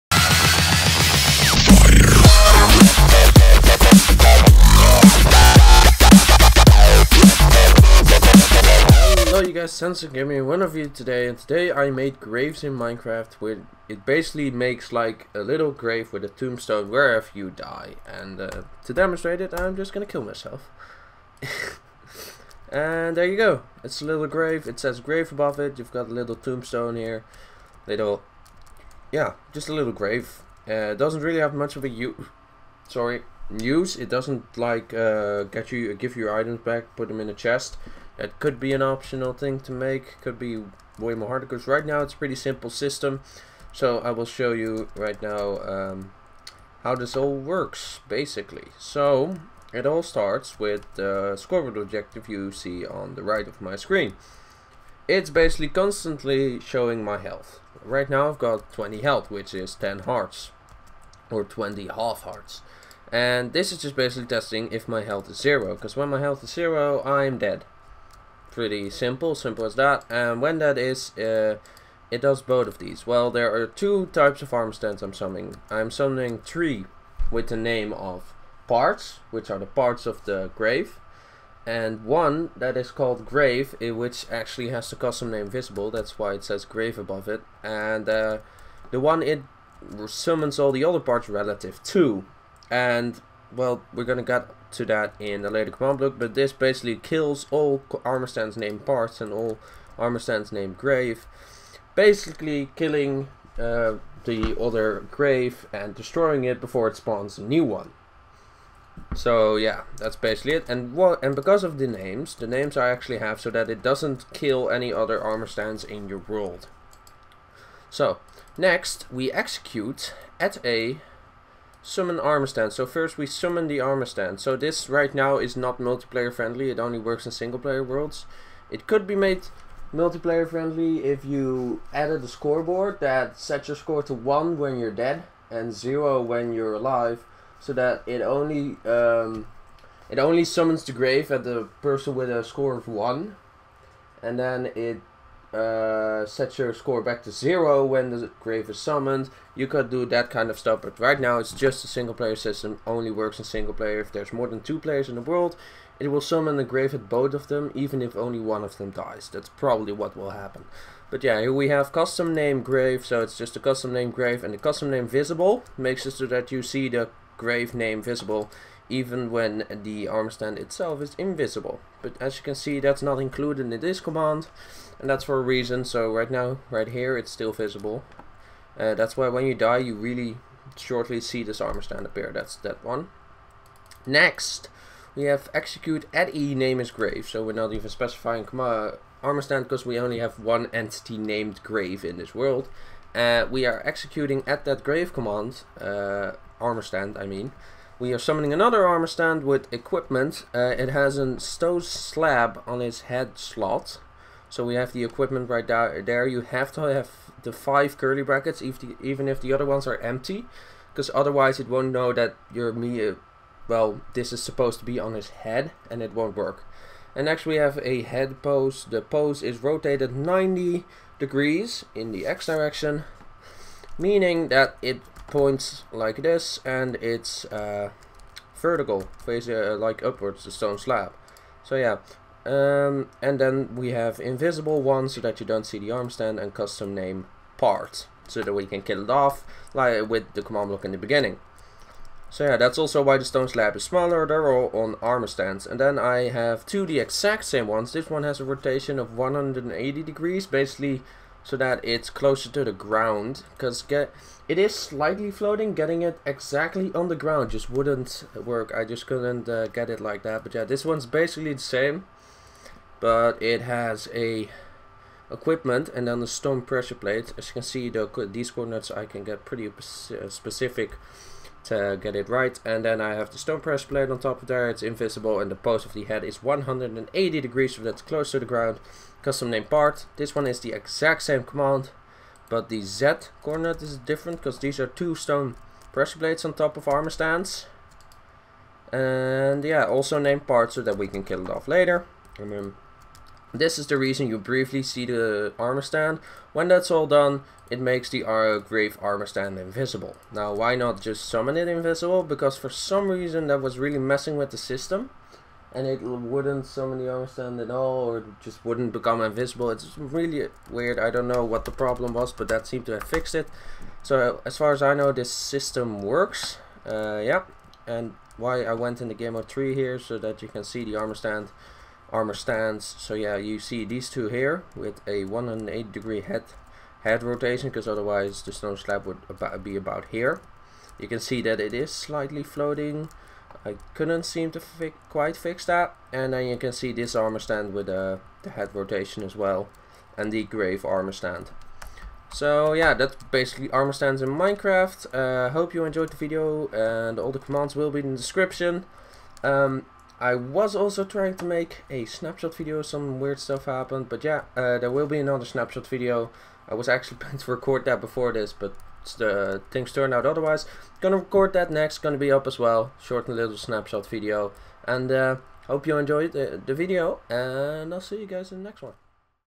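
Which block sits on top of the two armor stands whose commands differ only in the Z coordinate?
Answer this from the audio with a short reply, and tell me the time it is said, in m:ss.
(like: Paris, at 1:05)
Stone pressure plate, at 4:26.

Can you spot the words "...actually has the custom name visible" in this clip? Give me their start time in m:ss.
1:24.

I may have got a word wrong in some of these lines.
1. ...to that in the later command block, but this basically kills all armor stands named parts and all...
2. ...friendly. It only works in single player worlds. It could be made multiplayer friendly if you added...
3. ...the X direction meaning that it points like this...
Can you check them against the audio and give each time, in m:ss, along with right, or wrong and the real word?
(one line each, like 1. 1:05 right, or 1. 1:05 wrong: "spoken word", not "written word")
1. 1:34 right
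2. 2:06 right
3. 3:42 right.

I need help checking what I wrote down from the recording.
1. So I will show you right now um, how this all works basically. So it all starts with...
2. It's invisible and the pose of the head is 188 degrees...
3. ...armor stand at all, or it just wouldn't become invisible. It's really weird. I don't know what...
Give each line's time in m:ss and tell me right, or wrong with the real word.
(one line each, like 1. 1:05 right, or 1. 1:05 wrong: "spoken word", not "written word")
1. 0:43 right
2. 4:34 wrong: "180", not "188"
3. 5:07 right.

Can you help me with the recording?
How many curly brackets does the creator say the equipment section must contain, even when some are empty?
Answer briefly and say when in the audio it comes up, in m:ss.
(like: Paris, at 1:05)
5, at 3:27.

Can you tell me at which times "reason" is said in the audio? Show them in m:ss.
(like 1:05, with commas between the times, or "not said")
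2:55, 4:53, 5:03.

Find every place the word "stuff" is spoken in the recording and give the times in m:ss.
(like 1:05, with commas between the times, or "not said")
2:30, 5:53.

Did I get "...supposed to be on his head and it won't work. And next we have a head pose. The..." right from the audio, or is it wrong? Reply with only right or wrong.
right.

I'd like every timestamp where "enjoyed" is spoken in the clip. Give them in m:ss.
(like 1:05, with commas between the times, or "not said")
5:45, 6:05.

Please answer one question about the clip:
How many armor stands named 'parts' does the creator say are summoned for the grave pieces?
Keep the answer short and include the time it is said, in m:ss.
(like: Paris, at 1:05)
3, at 1:16.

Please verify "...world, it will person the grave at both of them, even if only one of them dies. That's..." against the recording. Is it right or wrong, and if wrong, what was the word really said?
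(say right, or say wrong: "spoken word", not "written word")
wrong: "summon", not "person".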